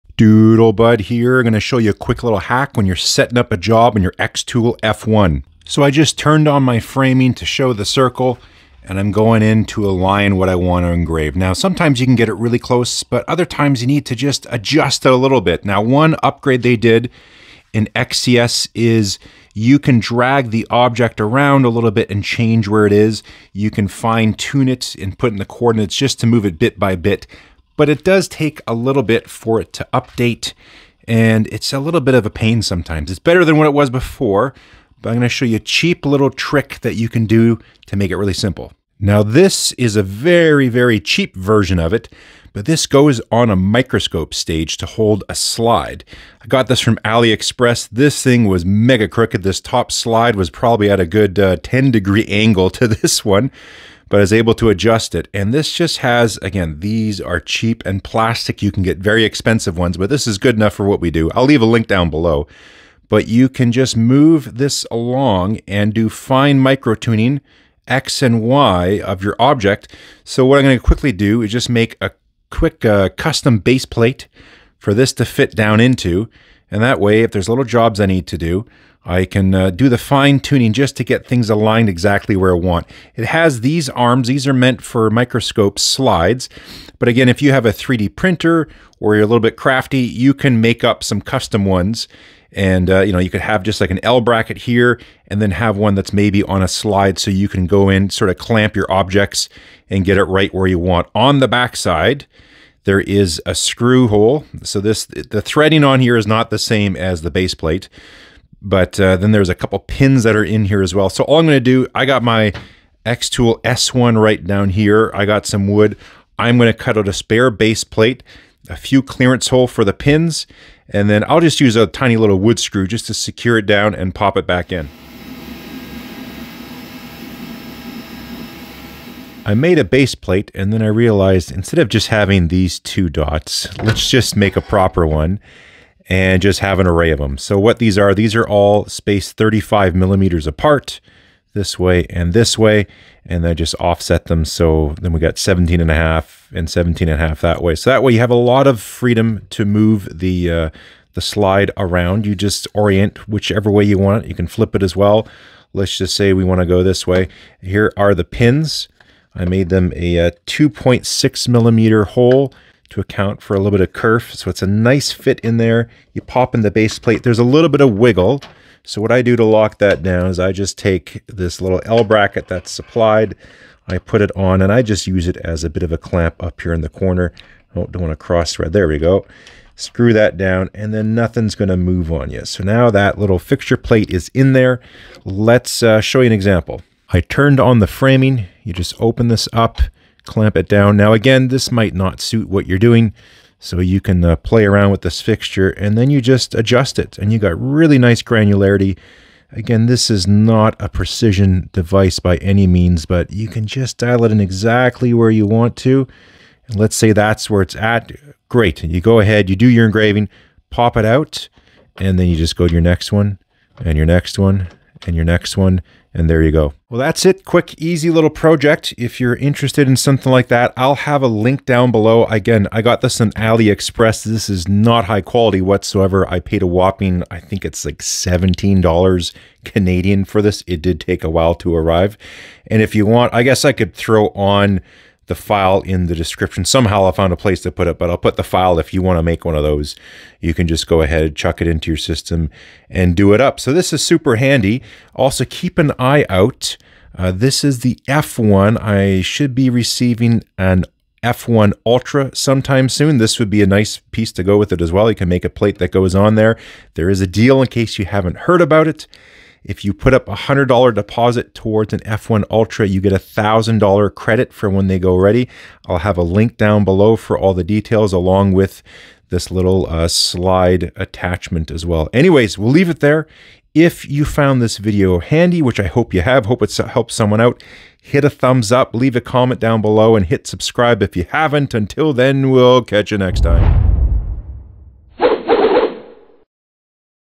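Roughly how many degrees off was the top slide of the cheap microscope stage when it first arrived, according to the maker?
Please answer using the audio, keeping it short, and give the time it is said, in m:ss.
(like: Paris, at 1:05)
10 degrees, at 0:51.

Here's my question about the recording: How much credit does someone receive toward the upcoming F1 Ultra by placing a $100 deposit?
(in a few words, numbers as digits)
$1,000.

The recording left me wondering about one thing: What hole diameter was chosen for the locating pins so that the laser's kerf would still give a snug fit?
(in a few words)
2.6 millimeters.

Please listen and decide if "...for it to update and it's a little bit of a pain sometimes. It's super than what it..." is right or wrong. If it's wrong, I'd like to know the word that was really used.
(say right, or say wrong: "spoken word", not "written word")
wrong: "better", not "super".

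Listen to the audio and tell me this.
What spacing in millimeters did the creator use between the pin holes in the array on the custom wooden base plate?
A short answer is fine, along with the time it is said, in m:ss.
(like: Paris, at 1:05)
35 millimeters, at 2:19.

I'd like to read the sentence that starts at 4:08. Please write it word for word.
I should be receiving an F1 Ultra sometime soon.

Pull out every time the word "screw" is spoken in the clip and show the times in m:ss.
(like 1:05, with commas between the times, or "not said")
1:43, 2:02, 2:59.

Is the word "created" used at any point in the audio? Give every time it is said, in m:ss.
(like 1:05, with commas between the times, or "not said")
not said.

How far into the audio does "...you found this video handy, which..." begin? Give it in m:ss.
4:34.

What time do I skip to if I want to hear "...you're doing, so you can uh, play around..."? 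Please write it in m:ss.
3:12.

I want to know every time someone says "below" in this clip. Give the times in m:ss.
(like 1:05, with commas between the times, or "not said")
1:02, 3:41, 4:26, 4:39.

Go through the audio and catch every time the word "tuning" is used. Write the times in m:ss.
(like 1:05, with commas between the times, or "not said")
1:06, 1:20.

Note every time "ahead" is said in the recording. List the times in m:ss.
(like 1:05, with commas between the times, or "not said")
3:29, 4:01.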